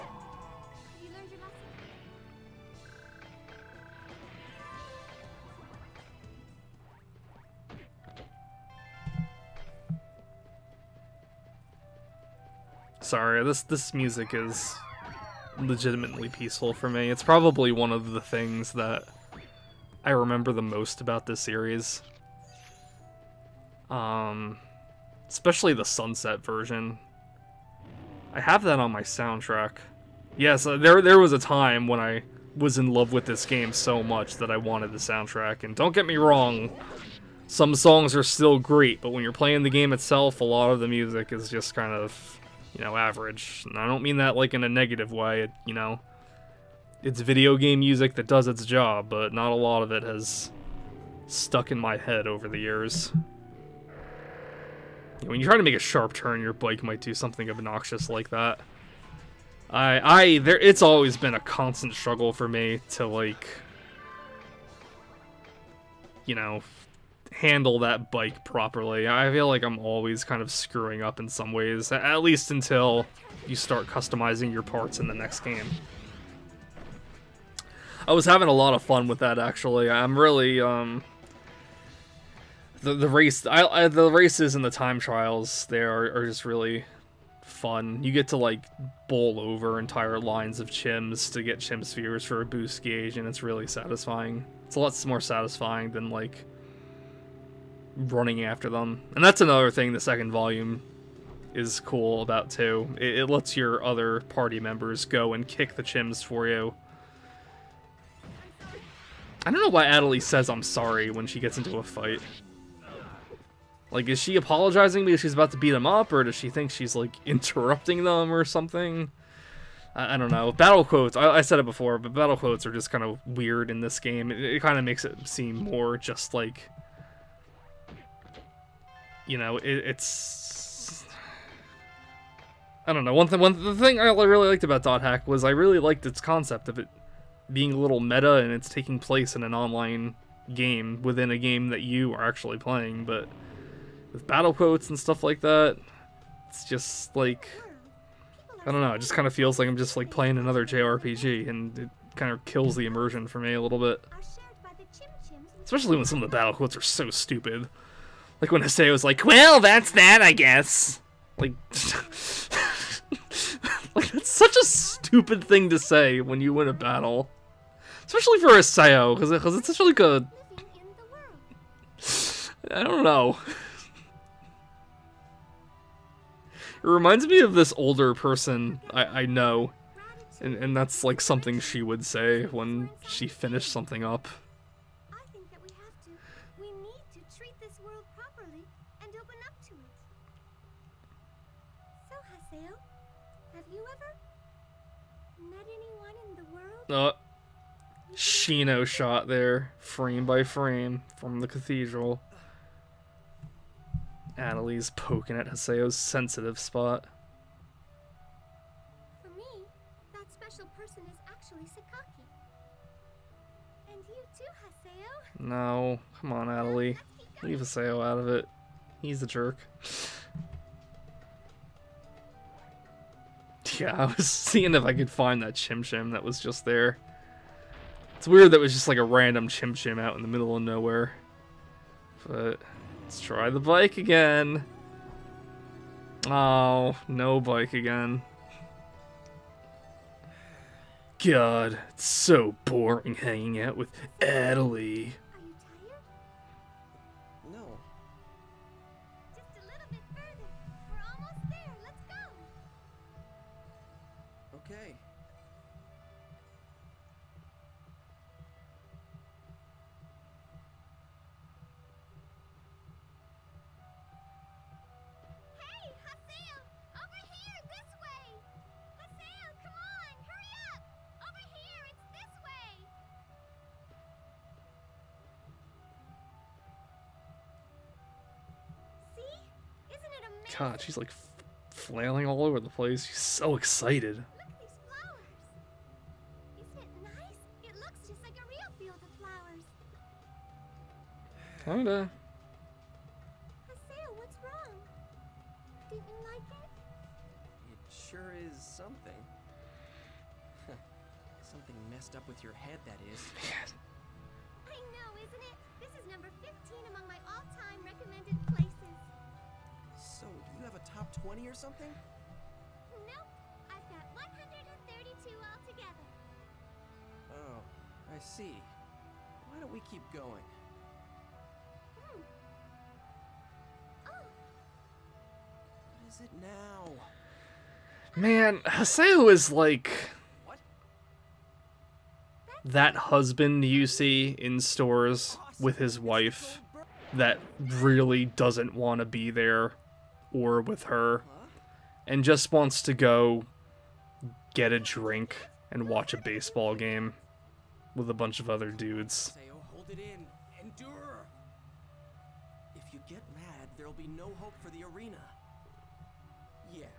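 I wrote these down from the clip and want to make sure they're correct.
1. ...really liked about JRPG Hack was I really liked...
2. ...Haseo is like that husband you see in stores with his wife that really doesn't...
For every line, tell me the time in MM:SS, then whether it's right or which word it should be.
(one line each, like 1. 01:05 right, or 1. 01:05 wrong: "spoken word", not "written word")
1. 02:14 wrong: "Dot", not "JRPG"
2. 05:28 right.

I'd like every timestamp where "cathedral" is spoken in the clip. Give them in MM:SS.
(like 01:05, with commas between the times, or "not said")
03:21.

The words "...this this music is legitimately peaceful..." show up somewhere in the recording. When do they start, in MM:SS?
00:13.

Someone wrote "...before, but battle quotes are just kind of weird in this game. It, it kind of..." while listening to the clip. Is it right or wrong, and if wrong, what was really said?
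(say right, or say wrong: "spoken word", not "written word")
right.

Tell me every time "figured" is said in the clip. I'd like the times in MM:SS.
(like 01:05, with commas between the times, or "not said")
not said.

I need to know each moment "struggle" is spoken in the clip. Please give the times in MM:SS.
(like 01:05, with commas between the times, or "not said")
01:01.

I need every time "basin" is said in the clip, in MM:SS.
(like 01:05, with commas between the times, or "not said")
not said.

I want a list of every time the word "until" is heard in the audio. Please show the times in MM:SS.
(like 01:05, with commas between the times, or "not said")
01:12.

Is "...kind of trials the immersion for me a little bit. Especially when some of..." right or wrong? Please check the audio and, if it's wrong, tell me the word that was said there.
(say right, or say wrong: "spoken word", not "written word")
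wrong: "kills", not "trials".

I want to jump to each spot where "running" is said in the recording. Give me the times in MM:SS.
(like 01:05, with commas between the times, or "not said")
01:37.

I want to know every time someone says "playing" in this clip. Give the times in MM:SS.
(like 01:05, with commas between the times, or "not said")
00:39, 02:22, 02:30.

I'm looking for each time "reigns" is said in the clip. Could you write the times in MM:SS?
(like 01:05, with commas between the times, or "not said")
not said.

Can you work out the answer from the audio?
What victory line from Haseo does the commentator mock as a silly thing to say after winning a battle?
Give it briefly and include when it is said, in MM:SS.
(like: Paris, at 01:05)
Well, that's that, I guess, at 02:39.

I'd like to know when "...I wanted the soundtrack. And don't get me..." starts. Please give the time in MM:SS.
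00:34.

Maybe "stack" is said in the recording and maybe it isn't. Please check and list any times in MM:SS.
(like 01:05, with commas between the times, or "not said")
not said.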